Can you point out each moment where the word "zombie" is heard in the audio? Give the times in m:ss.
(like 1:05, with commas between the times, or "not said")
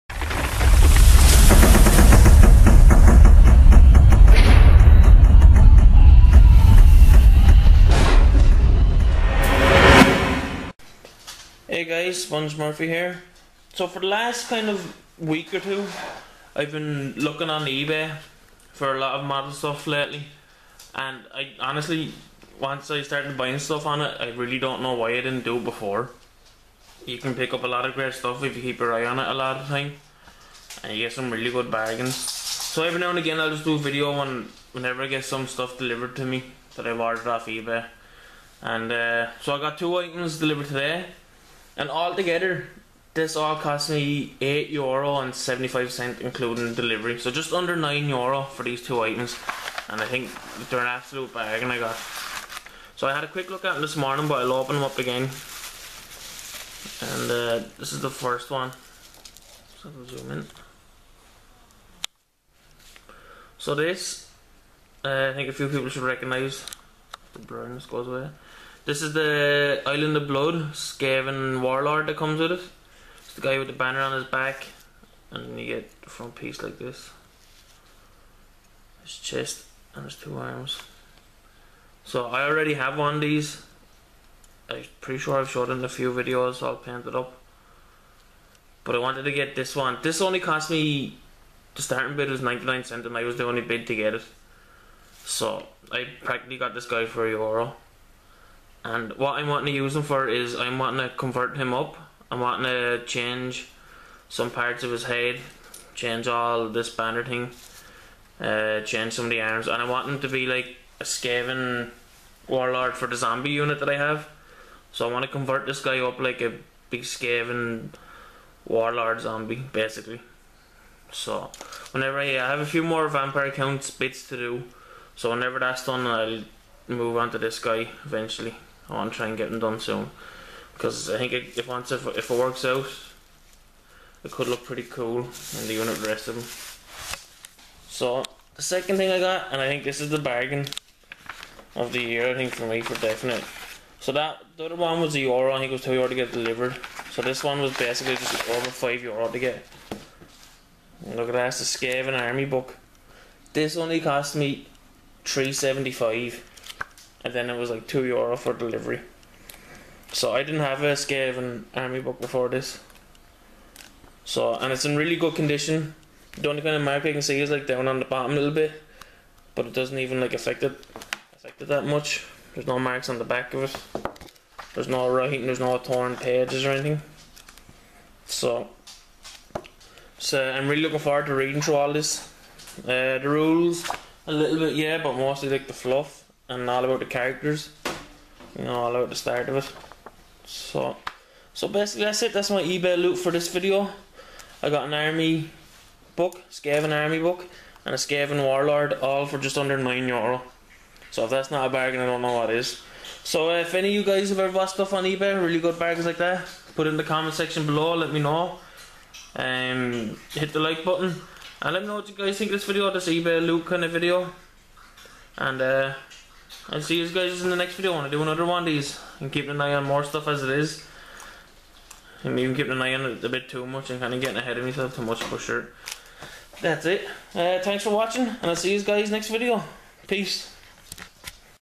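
1:53, 1:59.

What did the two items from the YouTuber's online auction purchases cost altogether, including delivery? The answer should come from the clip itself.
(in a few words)
8 euro 75 cent.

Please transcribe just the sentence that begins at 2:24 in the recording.
So that the other one was a euro, I think it was two euro to get delivered.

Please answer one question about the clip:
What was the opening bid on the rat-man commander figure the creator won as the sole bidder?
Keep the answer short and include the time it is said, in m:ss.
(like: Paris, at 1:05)
99 cents, at 1:32.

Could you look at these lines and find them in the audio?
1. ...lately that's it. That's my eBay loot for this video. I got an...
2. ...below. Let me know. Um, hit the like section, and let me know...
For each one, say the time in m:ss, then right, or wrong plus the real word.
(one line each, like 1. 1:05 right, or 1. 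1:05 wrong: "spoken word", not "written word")
1. 3:11 wrong: "basically", not "lately"
2. 3:27 wrong: "button", not "section".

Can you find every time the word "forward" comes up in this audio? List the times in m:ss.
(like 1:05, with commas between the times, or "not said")
3:00.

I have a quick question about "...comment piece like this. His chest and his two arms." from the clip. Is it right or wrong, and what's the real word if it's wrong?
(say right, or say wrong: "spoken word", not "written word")
wrong: "front", not "comment".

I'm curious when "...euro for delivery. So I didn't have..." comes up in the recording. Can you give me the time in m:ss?
2:38.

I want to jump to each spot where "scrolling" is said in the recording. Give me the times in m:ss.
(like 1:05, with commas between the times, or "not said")
not said.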